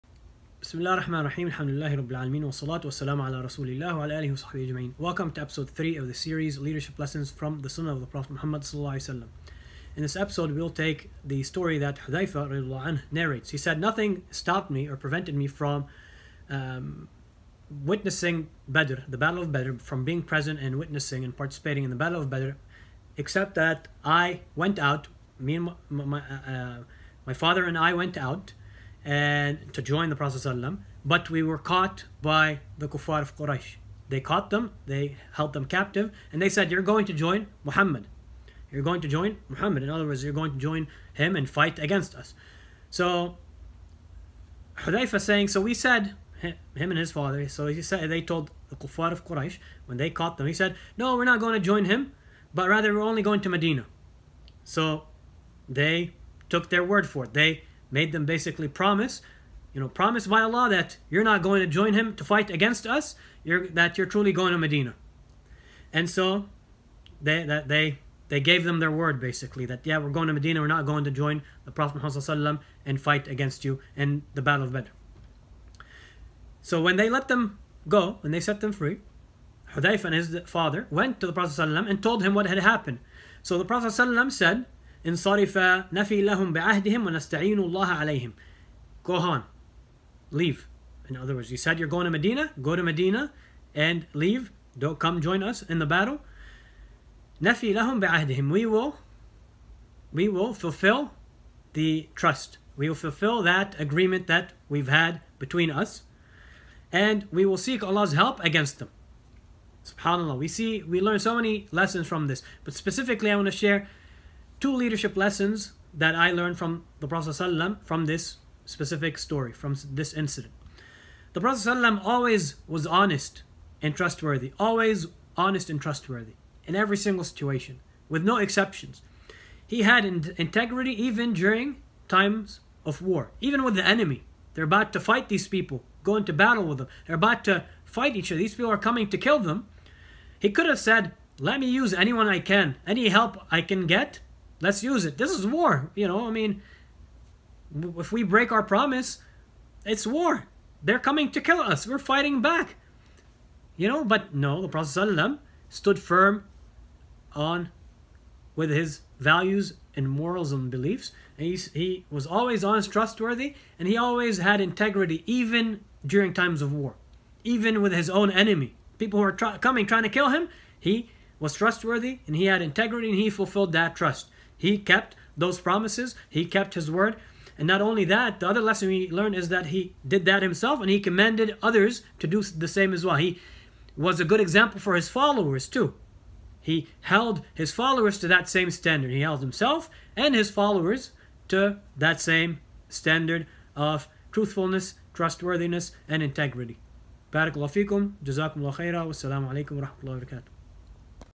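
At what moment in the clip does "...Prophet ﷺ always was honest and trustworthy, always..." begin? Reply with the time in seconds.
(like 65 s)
121 s.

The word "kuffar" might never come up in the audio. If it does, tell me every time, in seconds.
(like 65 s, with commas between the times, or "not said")
32 s, 48 s.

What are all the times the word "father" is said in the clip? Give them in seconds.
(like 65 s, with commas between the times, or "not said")
27 s, 47 s, 80 s.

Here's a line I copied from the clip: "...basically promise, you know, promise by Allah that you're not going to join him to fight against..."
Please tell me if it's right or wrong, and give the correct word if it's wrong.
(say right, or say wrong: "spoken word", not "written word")
right.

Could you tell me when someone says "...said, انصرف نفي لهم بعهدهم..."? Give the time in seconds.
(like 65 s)
83 s.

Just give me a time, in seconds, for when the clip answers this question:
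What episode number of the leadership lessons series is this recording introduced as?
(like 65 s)
5 s.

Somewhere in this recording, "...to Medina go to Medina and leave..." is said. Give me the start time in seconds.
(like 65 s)
92 s.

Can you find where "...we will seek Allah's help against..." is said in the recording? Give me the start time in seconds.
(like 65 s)
107 s.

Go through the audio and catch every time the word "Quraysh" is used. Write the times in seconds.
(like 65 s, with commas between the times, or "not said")
33 s, 49 s.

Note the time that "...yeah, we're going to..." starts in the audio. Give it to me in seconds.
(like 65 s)
69 s.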